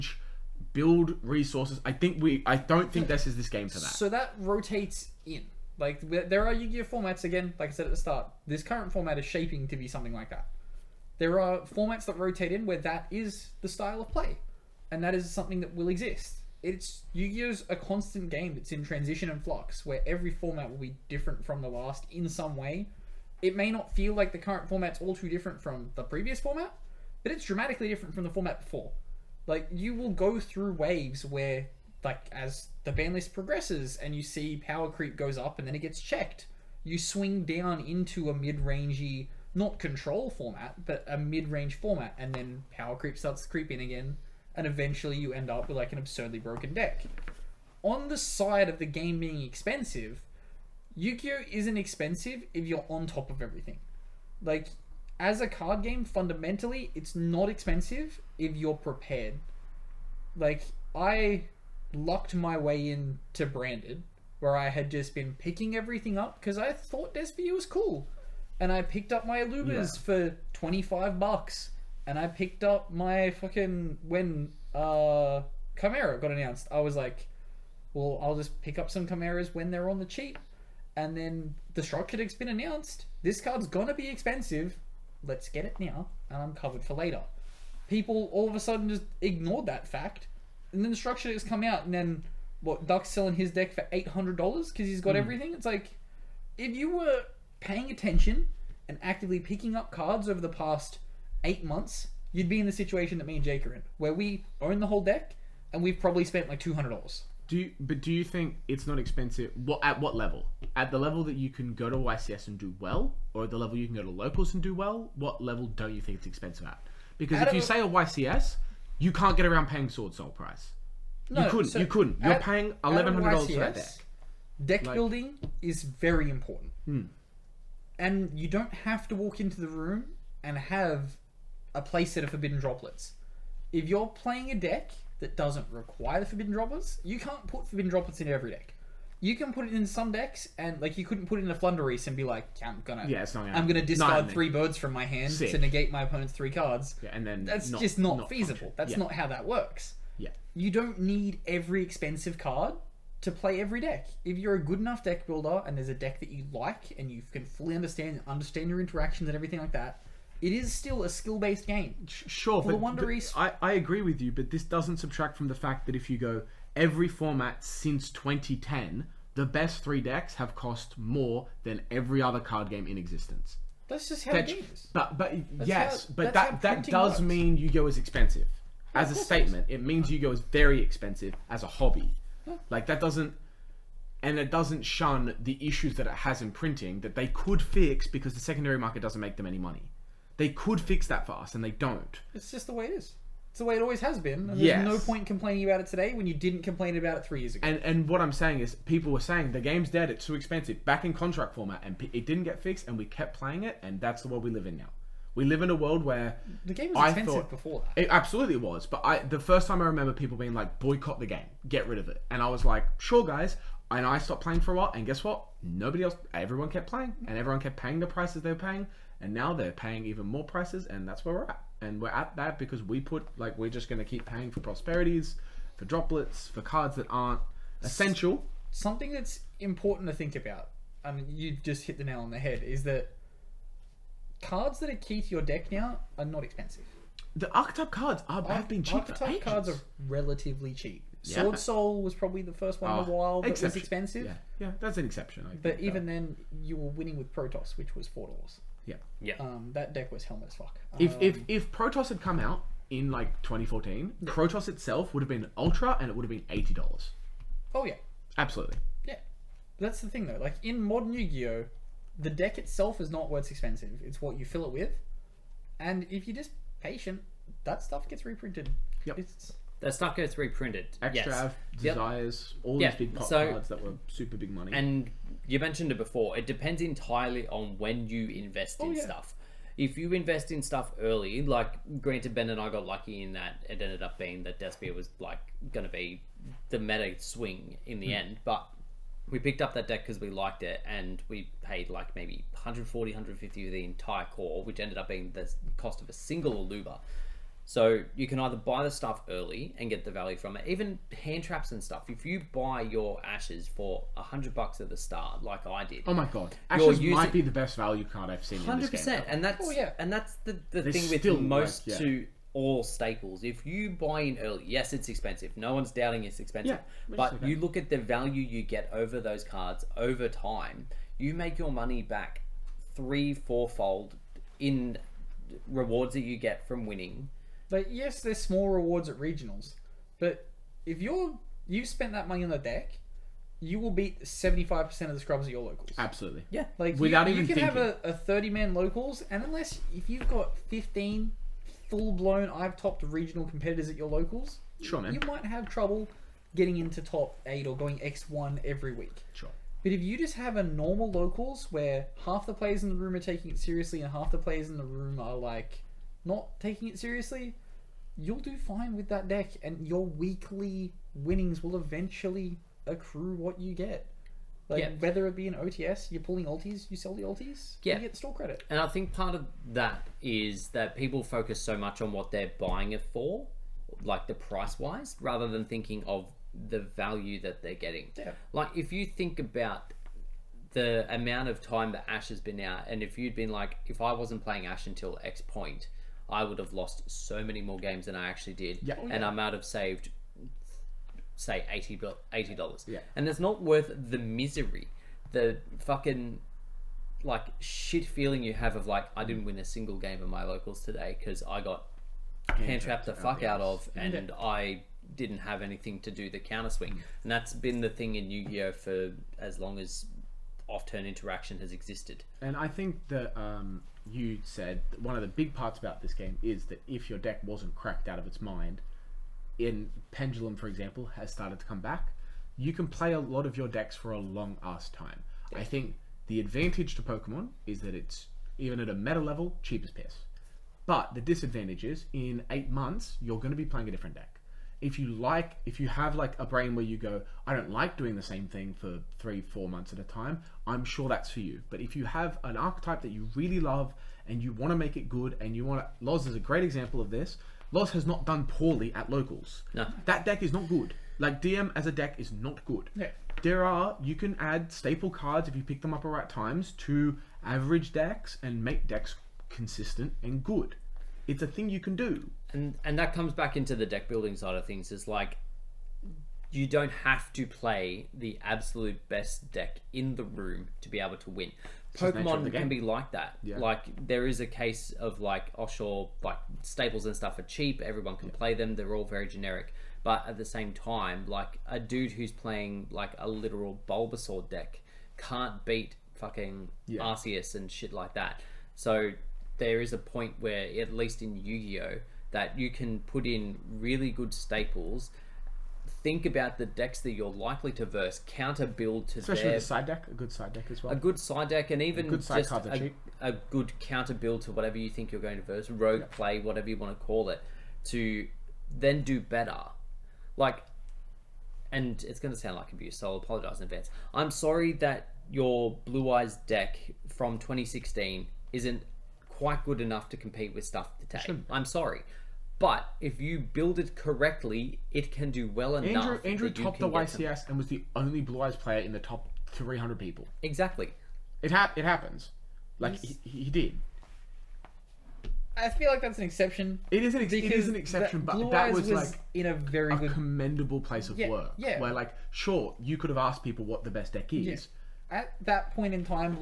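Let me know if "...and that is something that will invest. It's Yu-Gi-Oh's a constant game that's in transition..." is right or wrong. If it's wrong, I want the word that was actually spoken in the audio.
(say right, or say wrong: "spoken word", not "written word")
wrong: "exist", not "invest".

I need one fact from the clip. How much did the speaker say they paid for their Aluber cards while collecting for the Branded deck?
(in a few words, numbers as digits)
$25.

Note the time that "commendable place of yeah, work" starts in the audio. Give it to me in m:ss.
9:00.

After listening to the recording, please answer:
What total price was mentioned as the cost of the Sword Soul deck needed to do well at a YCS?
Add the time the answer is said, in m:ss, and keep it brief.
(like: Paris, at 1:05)
$1,100, at 2:02.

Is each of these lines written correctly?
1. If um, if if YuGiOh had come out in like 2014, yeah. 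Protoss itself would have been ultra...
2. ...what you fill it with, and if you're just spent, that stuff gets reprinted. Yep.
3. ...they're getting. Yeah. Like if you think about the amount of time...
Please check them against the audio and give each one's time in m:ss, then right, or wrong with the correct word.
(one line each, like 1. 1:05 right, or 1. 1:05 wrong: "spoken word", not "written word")
1. 4:10 wrong: "Protoss", not "YuGiOh"
2. 4:24 wrong: "patient", not "spent"
3. 6:17 right.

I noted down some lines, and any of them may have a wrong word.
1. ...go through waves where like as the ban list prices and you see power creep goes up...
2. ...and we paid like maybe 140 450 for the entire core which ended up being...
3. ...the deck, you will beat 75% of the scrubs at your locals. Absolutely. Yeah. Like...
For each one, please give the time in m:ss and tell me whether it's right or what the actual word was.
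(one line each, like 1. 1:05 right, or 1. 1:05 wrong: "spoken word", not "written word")
1. 0:30 wrong: "progresses", not "prices"
2. 4:50 wrong: "150", not "450"
3. 5:32 right.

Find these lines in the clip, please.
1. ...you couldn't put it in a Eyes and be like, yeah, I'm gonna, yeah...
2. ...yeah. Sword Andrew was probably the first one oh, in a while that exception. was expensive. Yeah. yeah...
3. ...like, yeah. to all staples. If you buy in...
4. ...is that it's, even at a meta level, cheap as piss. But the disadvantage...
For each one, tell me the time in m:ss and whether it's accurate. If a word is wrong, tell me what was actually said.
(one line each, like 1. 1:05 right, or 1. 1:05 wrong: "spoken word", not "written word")
1. 2:20 wrong: "Floowandereeze", not "Eyes"
2. 4:01 wrong: "Soul", not "Andrew"
3. 5:11 right
4. 7:07 right.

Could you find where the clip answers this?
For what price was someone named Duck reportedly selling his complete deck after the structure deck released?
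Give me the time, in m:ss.
1:33.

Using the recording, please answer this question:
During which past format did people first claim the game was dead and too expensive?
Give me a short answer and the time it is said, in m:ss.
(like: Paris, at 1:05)
Contract format, at 3:21.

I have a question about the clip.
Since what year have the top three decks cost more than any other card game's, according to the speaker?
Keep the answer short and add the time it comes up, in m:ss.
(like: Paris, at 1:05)
2010, at 2:48.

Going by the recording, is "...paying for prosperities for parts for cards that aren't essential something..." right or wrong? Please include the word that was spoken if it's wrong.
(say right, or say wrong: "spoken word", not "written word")
wrong: "droplets", not "parts".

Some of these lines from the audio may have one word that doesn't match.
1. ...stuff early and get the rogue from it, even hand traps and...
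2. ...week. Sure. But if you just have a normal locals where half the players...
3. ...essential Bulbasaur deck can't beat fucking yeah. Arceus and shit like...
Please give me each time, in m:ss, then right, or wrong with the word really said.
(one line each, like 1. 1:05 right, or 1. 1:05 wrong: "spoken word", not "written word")
1. 4:58 wrong: "value", not "rogue"
2. 5:48 right
3. 8:03 wrong: "literal", not "essential".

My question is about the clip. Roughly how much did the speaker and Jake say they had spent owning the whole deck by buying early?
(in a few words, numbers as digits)
$200.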